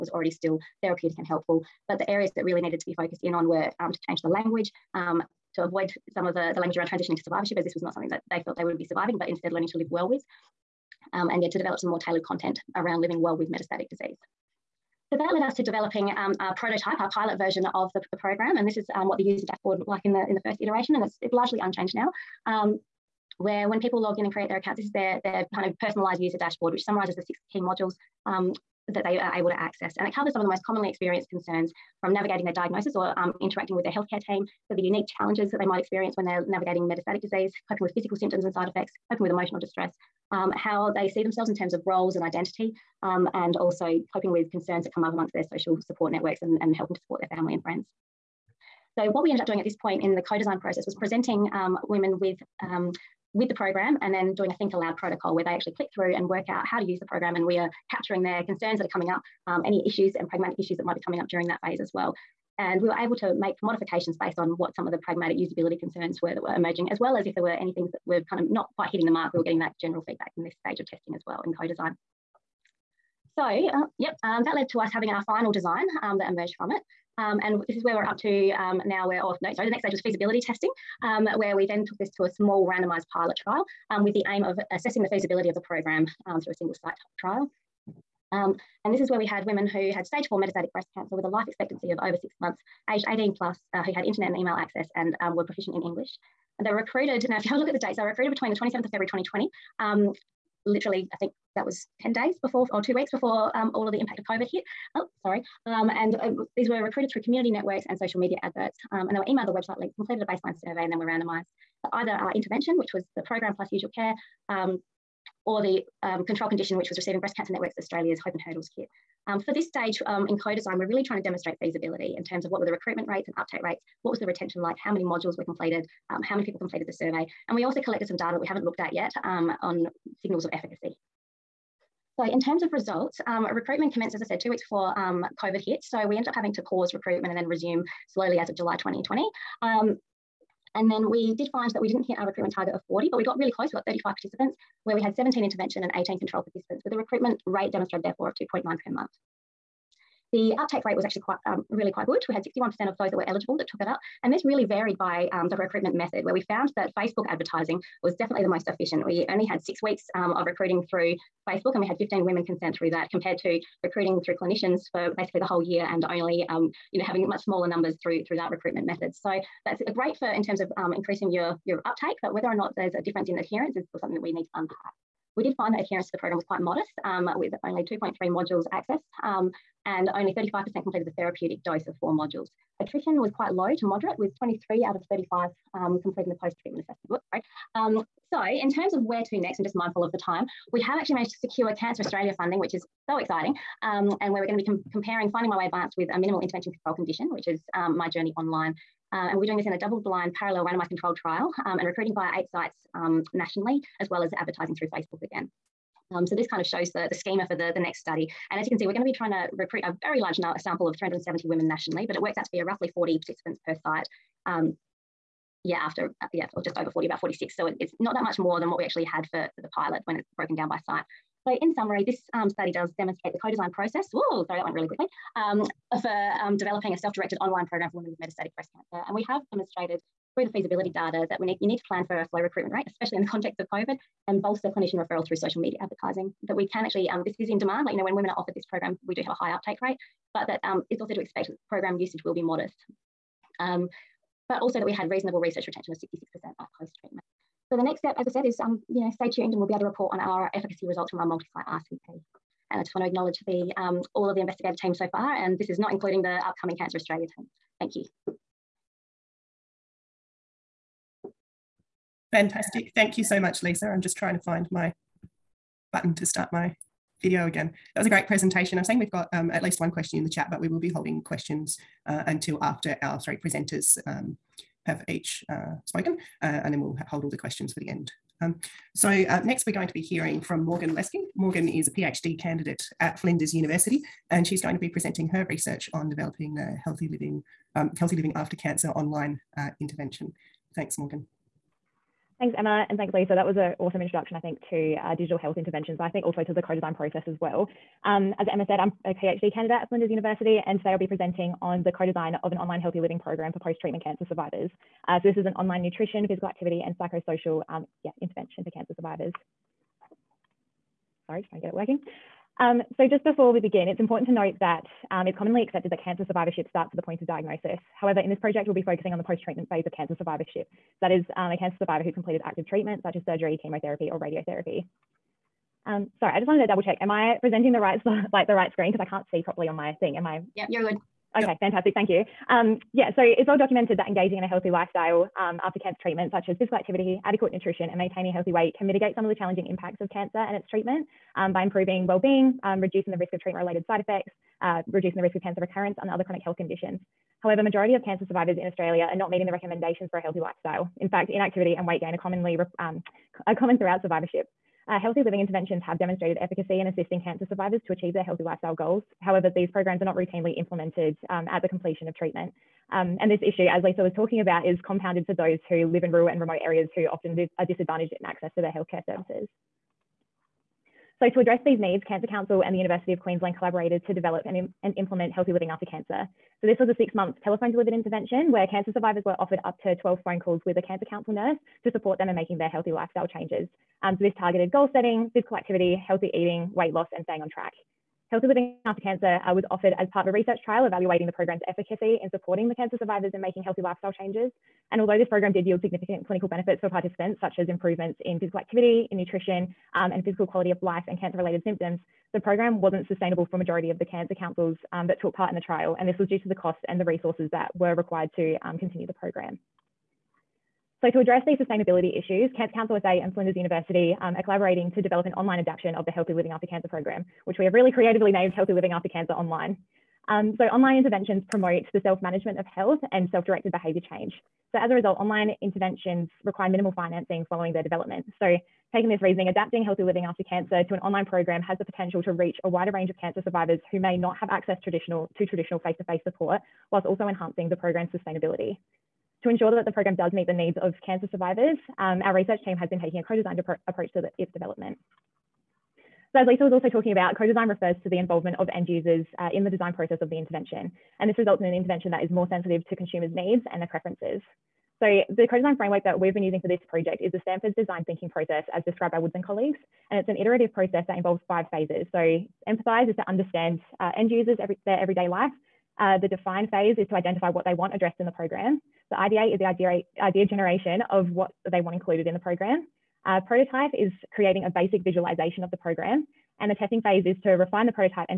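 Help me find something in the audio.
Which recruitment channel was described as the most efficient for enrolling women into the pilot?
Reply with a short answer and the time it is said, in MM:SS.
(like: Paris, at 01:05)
Facebook advertising, at 02:36.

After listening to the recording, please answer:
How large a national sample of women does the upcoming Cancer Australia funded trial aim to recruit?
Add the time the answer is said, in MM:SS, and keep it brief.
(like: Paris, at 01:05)
370, at 03:30.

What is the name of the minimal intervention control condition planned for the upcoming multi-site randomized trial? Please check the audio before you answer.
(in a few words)
My Journey Online.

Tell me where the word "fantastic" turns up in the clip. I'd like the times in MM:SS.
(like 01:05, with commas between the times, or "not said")
04:22, 05:31.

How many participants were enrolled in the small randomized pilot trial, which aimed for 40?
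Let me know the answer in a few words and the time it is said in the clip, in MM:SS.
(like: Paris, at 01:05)
35, at 02:23.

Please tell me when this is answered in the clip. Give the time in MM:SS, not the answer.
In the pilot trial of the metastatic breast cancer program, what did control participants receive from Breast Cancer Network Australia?
01:58.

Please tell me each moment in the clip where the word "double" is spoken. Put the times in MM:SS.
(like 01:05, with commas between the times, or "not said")
03:19, 05:26.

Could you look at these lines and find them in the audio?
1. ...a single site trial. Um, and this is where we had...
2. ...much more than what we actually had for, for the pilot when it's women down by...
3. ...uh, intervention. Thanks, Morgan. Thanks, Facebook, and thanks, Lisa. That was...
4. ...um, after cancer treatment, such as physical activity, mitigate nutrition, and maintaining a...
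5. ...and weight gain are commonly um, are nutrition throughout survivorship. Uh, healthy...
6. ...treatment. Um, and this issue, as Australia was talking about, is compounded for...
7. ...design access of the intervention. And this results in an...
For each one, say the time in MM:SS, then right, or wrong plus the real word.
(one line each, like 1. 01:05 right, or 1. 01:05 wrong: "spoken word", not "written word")
1. 01:26 right
2. 03:38 wrong: "broken", not "women"
3. 04:49 wrong: "Emma", not "Facebook"
4. 05:35 wrong: "adequate", not "mitigate"
5. 05:51 wrong: "common", not "nutrition"
6. 06:02 wrong: "Lisa", not "Australia"
7. 07:29 wrong: "process", not "access".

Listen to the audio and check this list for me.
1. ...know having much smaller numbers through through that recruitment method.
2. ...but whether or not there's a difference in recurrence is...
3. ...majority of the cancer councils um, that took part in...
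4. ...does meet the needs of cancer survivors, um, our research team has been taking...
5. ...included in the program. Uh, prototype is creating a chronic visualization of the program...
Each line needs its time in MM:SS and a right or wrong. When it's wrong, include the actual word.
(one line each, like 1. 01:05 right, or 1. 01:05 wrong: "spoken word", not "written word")
1. 02:46 right
2. 02:52 wrong: "adherence", not "recurrence"
3. 06:43 right
4. 07:20 right
5. 07:51 wrong: "basic", not "chronic".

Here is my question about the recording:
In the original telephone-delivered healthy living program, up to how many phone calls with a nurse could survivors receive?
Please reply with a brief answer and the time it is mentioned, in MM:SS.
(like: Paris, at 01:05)
12, at 06:20.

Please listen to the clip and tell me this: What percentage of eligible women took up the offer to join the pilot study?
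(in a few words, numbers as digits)
61%.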